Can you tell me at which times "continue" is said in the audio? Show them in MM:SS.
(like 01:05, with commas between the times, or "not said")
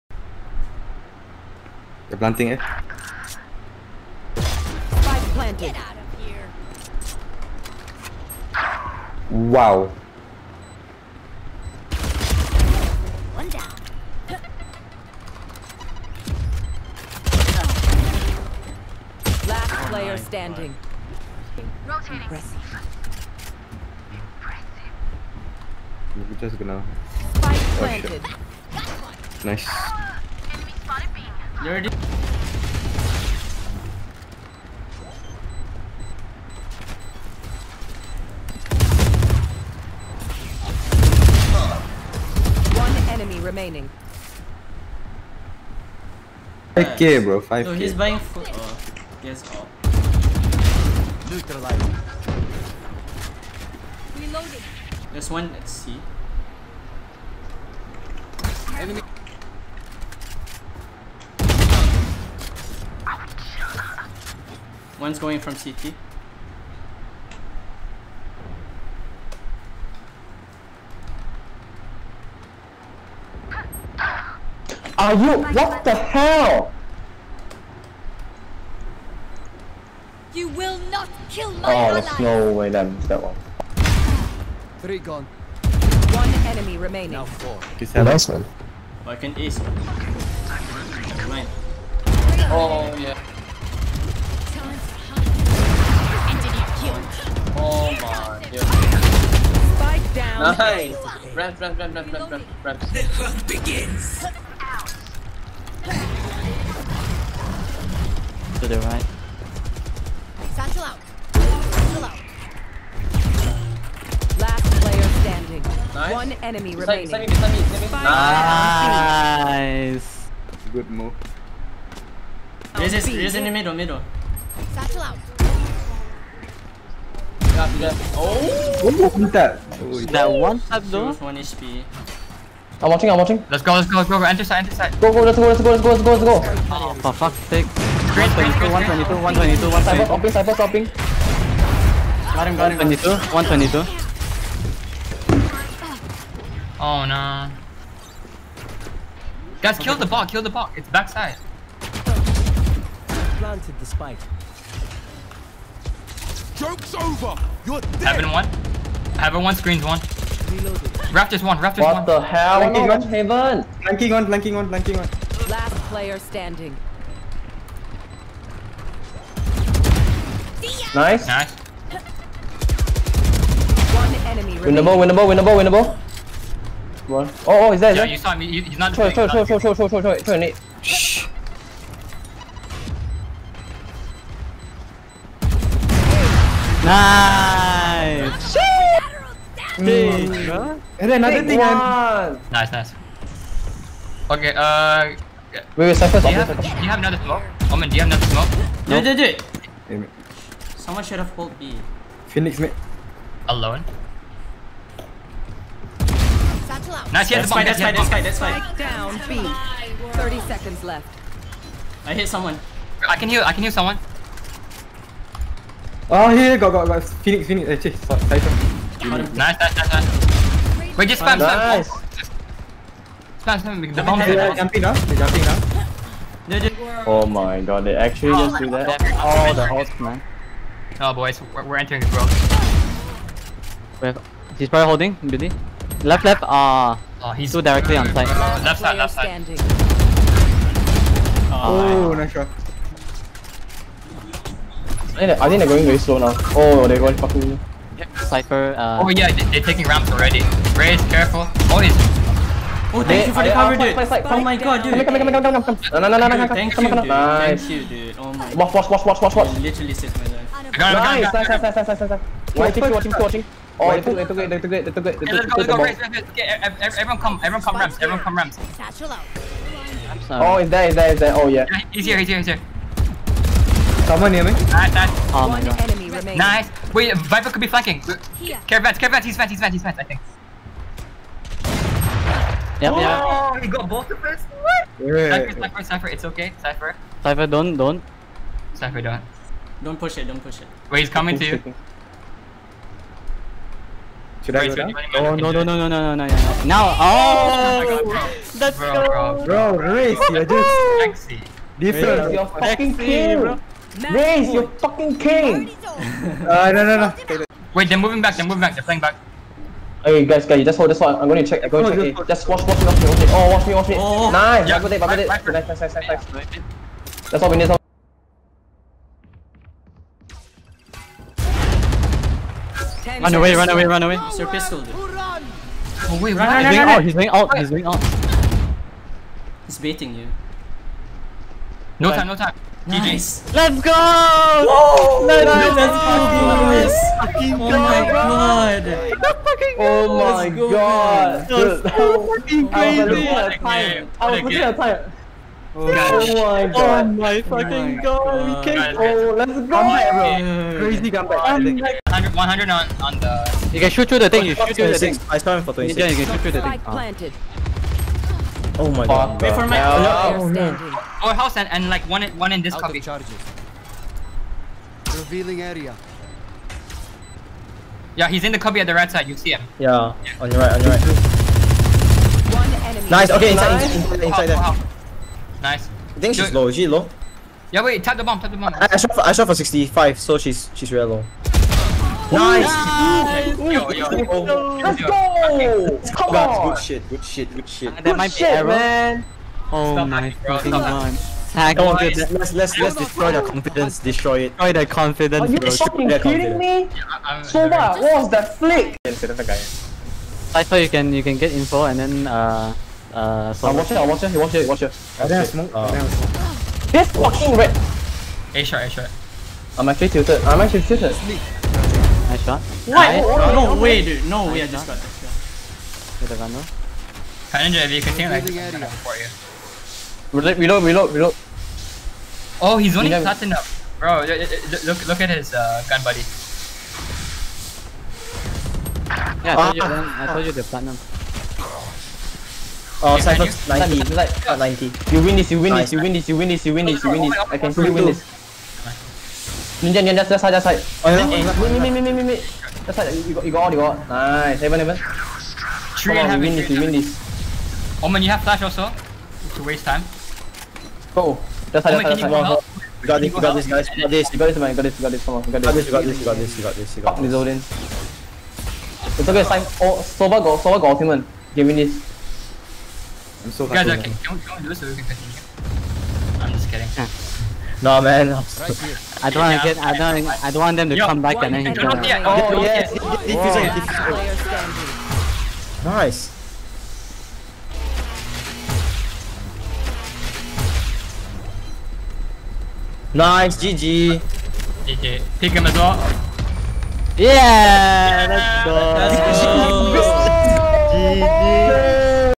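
06:58, 07:45.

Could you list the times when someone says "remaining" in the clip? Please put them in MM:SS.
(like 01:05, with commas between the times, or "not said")
00:43, 01:26, 01:56, 04:36.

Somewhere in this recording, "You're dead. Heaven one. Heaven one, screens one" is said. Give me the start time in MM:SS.
02:37.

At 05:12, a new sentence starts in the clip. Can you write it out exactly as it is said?
Hey, just watch, watch me, watch me, watch me.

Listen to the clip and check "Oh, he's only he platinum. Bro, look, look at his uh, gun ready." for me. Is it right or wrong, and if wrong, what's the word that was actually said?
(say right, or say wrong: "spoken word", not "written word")
wrong: "buddy", not "ready".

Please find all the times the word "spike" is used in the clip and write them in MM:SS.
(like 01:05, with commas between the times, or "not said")
00:27, 02:33.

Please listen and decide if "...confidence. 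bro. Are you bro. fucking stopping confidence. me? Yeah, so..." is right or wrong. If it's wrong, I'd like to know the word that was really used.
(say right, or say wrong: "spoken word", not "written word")
wrong: "kidding", not "stopping".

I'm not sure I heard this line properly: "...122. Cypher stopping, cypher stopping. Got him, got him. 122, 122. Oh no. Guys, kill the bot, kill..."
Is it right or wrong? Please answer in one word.
right.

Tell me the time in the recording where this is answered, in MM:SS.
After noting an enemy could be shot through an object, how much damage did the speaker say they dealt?
05:55.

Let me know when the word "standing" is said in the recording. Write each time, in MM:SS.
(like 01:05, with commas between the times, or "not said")
00:20, 01:55, 02:46.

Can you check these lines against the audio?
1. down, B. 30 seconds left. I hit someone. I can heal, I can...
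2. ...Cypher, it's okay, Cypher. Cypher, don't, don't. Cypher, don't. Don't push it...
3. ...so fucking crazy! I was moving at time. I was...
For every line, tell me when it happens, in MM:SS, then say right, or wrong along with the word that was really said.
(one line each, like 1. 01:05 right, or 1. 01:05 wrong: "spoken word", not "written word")
1. 03:28 right
2. 04:45 right
3. 05:41 wrong: "looking", not "moving".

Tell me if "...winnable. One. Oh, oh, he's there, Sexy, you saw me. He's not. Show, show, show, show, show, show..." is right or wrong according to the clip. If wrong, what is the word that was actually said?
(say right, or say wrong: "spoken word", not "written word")
wrong: "Yeah", not "Sexy".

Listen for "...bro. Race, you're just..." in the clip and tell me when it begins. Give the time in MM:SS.
04:59.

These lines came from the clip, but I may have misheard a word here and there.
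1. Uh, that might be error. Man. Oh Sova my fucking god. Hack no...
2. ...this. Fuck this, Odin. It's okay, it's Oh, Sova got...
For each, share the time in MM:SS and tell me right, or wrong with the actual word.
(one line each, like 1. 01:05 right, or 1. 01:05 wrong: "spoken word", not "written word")
1. 06:27 wrong: "Stop", not "Sova"
2. 07:37 right.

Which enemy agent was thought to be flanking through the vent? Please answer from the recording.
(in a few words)
Viper.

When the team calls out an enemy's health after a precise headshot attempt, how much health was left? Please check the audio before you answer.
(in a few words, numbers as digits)
One HP.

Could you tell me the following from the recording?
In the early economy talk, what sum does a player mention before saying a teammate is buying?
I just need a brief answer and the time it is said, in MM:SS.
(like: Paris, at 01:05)
5k, at 00:47.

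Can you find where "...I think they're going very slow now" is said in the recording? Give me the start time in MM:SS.
04:05.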